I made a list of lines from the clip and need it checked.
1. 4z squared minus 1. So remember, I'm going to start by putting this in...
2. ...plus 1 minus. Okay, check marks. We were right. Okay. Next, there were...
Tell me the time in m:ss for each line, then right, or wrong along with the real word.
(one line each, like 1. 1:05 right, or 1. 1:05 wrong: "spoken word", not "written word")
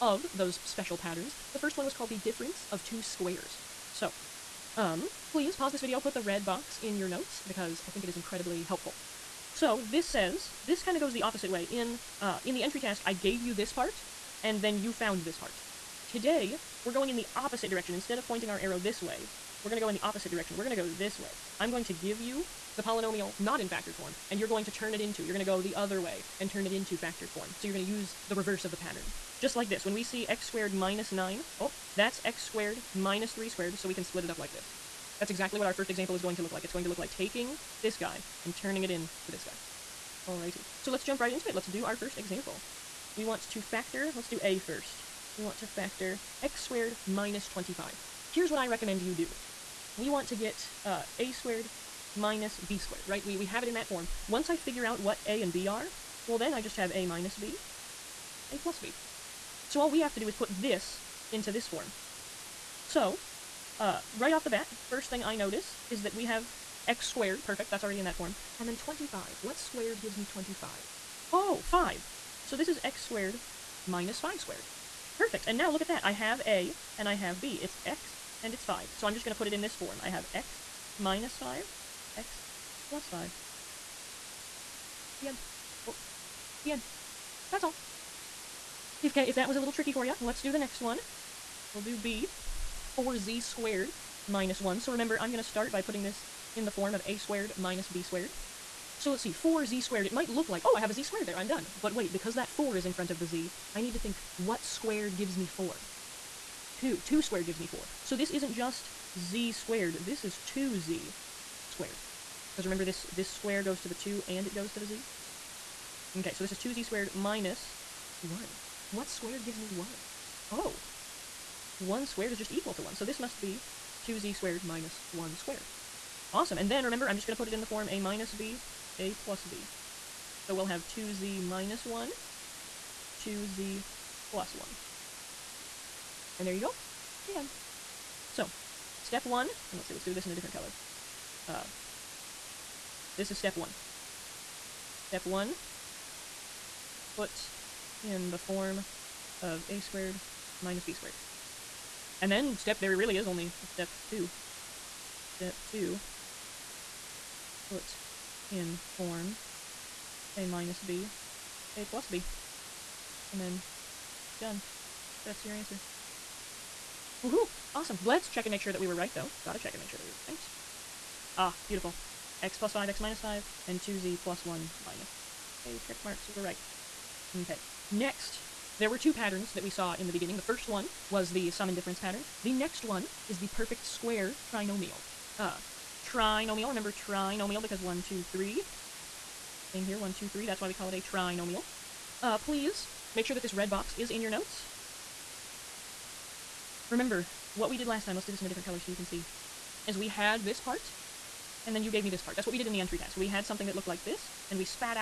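1. 1:32 right
2. 2:54 right.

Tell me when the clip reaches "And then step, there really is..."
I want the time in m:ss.
2:32.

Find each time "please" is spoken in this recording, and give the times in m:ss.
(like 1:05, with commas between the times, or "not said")
0:05, 3:12.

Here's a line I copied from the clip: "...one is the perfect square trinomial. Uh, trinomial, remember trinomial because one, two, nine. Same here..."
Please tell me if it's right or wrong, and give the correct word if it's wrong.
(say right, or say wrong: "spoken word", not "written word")
wrong: "three", not "nine".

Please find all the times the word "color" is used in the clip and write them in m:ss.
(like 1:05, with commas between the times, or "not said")
2:20, 3:18.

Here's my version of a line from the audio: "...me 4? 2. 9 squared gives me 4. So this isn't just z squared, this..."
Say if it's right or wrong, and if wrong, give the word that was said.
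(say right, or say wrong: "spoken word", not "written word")
wrong: "2", not "9".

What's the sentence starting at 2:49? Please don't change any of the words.
Gotta check and make sure that we were right.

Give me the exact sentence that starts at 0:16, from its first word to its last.
Today, we're going in the opposite direction.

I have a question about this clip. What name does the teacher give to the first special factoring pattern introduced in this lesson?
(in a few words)
difference of two squares.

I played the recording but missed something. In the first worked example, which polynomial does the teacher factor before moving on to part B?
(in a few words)
x squared minus 25.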